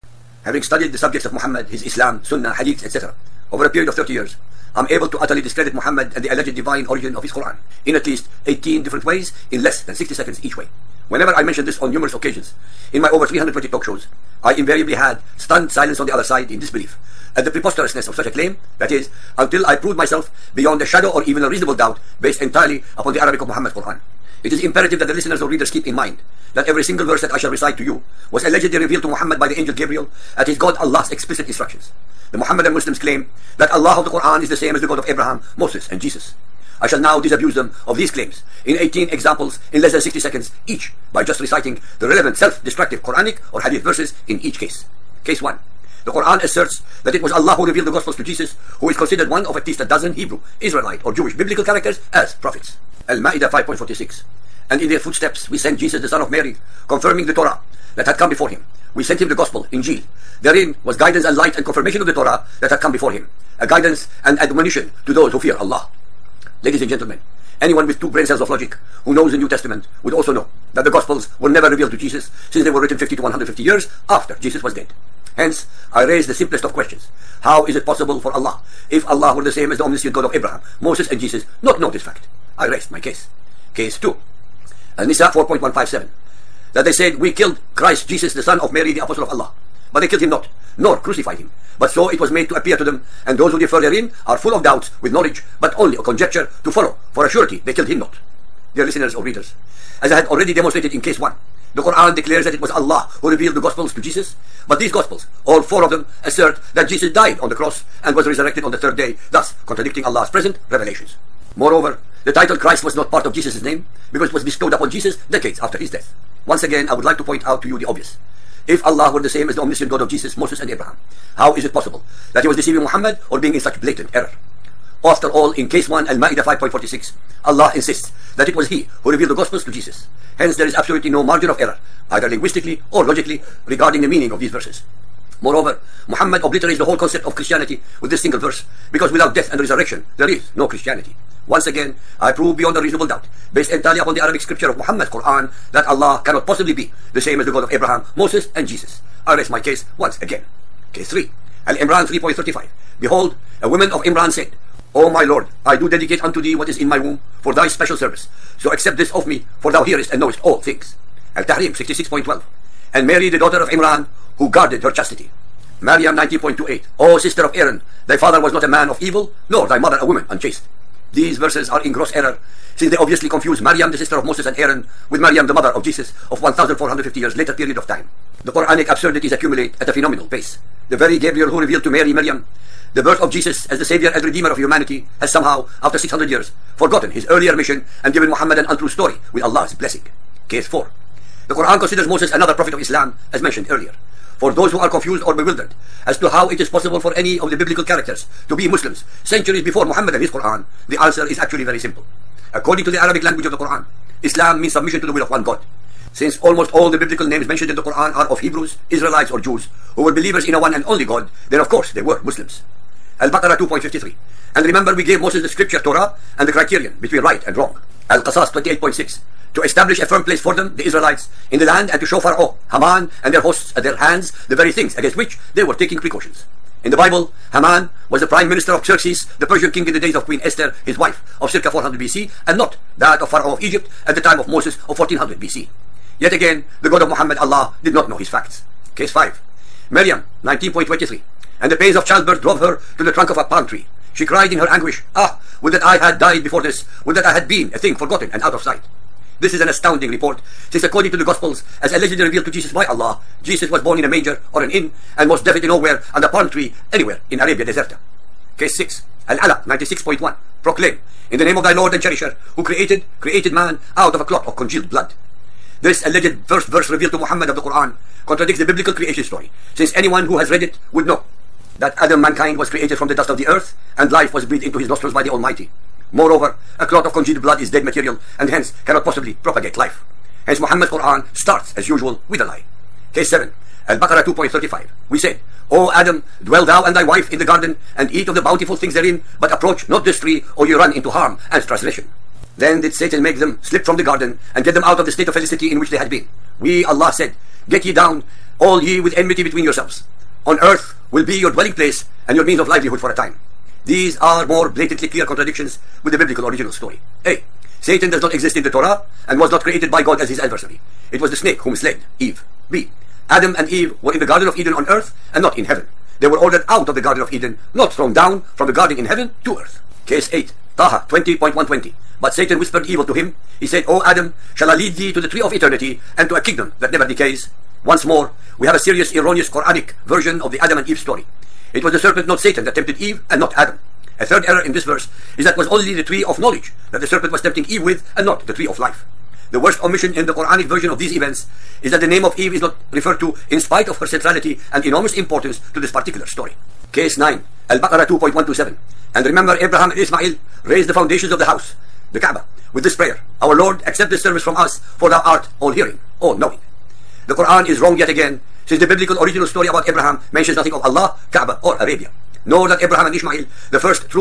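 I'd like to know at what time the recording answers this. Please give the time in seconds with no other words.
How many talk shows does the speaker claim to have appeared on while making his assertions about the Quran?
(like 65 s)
13 s.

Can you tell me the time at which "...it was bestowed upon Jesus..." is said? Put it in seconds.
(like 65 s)
114 s.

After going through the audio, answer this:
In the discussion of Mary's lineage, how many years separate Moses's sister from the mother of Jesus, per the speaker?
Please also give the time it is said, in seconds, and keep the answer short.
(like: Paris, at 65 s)
1450, at 176 s.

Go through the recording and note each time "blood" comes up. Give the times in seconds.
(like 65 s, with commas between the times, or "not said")
264 s, 277 s.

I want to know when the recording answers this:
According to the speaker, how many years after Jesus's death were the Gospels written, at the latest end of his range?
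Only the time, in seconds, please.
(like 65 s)
73 s.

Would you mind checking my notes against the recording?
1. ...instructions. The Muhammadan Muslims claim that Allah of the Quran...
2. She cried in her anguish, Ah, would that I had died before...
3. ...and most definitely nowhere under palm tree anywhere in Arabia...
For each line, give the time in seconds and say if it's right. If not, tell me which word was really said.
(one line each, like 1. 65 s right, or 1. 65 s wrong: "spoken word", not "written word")
1. 31 s right
2. 244 s right
3. 255 s right.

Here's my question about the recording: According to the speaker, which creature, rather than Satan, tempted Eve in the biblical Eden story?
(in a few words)
the snake.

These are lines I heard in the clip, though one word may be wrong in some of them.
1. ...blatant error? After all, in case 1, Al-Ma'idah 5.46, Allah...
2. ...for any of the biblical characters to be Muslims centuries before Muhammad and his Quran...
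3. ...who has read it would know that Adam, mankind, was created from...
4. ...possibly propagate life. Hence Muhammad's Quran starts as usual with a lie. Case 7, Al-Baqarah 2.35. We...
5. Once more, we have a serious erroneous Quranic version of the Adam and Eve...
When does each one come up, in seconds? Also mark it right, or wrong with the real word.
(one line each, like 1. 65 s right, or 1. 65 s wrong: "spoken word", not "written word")
1. 123 s right
2. 196 s right
3. 270 s right
4. 279 s right
5. 327 s right.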